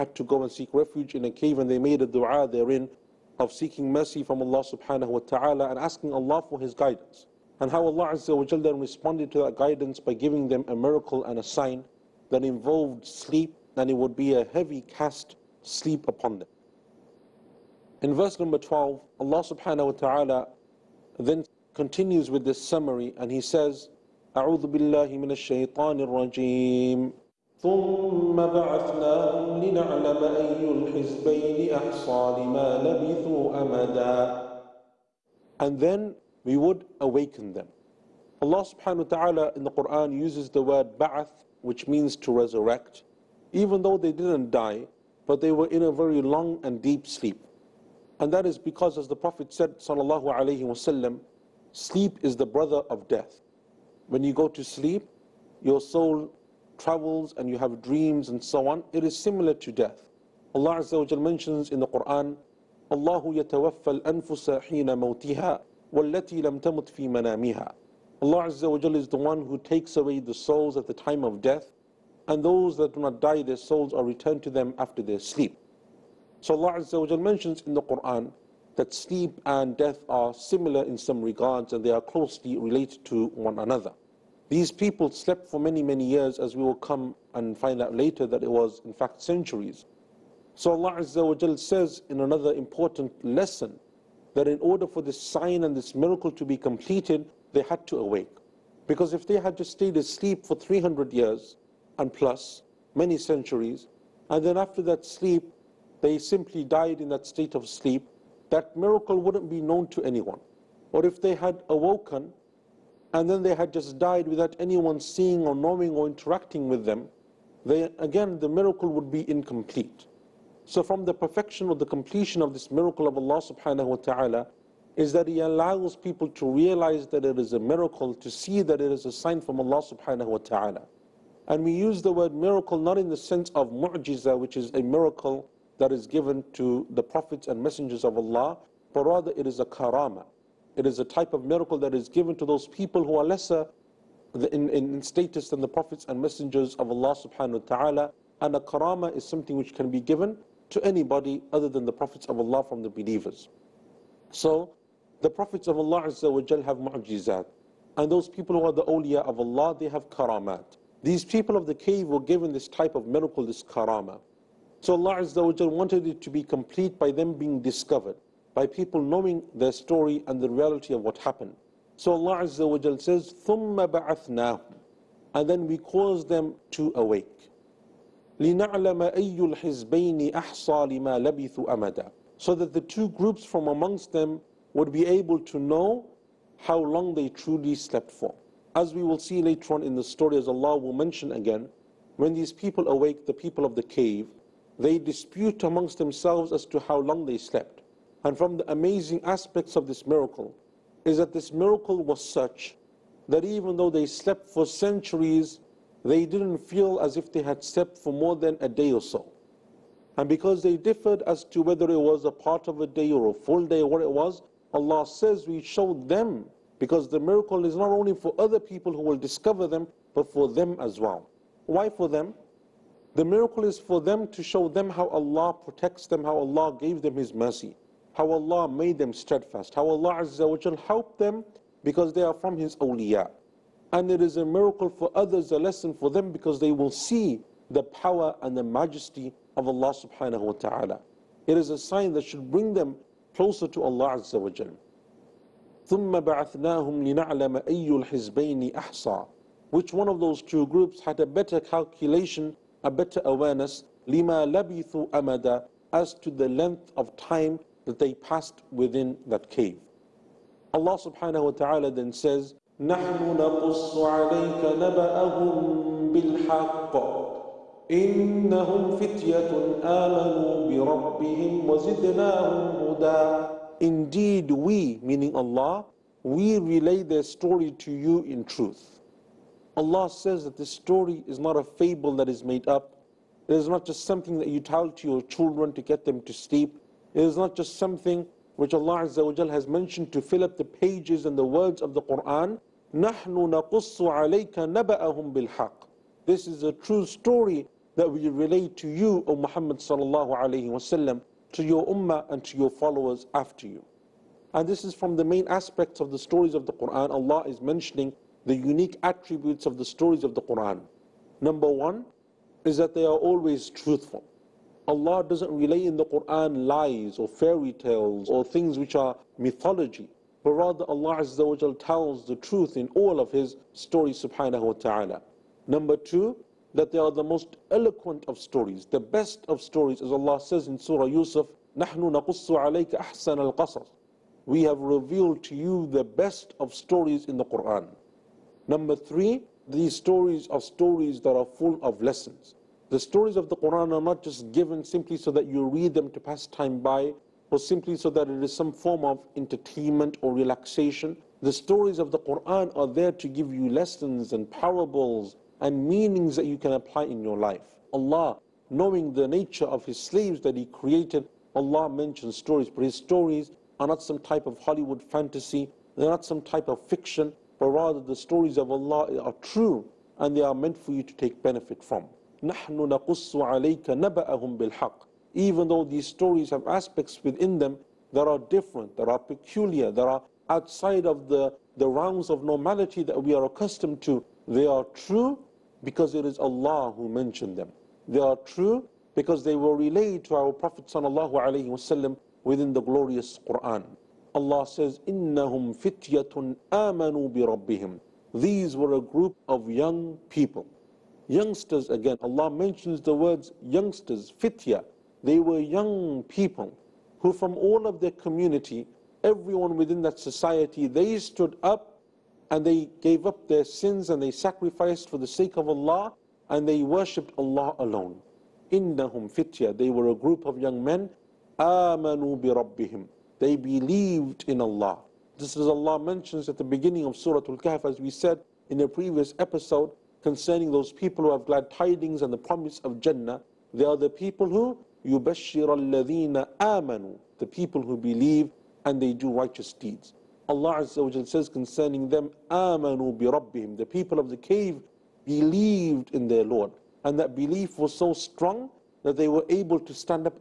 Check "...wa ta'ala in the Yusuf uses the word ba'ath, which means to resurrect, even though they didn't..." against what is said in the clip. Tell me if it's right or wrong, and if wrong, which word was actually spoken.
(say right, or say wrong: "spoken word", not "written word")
wrong: "Quran", not "Yusuf".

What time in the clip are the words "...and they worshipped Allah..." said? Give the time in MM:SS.
06:56.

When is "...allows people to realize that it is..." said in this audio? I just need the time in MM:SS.
02:05.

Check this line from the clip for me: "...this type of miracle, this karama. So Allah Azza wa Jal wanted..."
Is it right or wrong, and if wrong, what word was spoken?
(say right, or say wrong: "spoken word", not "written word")
right.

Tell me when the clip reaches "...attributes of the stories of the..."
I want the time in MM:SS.
05:09.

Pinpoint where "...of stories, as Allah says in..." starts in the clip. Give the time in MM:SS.
05:29.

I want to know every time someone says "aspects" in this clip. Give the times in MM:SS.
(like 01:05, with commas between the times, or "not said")
03:19, 05:05, 06:16.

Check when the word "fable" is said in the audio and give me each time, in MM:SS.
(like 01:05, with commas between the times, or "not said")
04:41.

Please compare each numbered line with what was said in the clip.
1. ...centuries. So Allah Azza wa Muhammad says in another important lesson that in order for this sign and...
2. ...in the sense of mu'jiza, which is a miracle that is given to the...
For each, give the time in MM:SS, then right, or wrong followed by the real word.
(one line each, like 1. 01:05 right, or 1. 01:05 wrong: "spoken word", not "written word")
1. 01:29 wrong: "Jal", not "Muhammad"
2. 02:12 right.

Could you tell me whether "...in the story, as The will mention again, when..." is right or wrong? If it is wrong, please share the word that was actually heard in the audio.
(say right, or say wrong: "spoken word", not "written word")
wrong: "Allah", not "The".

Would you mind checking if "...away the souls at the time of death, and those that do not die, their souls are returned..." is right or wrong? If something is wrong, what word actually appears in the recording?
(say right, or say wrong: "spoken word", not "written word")
right.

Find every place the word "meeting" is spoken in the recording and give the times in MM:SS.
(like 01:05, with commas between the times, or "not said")
not said.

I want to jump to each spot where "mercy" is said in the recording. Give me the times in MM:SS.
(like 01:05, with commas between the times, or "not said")
00:03, 03:47.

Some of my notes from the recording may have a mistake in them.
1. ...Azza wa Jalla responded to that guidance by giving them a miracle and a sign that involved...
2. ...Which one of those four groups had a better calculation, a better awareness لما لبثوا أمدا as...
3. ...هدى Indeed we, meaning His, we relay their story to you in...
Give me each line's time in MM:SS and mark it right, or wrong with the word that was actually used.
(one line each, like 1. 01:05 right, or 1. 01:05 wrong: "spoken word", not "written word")
1. 00:08 right
2. 04:09 wrong: "two", not "four"
3. 04:32 wrong: "Allah", not "His".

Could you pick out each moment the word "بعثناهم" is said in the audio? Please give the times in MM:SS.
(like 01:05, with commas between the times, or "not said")
00:28, 02:53, 04:06.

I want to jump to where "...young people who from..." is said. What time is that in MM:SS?
06:45.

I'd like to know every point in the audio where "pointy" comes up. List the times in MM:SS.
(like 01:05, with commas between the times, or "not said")
not said.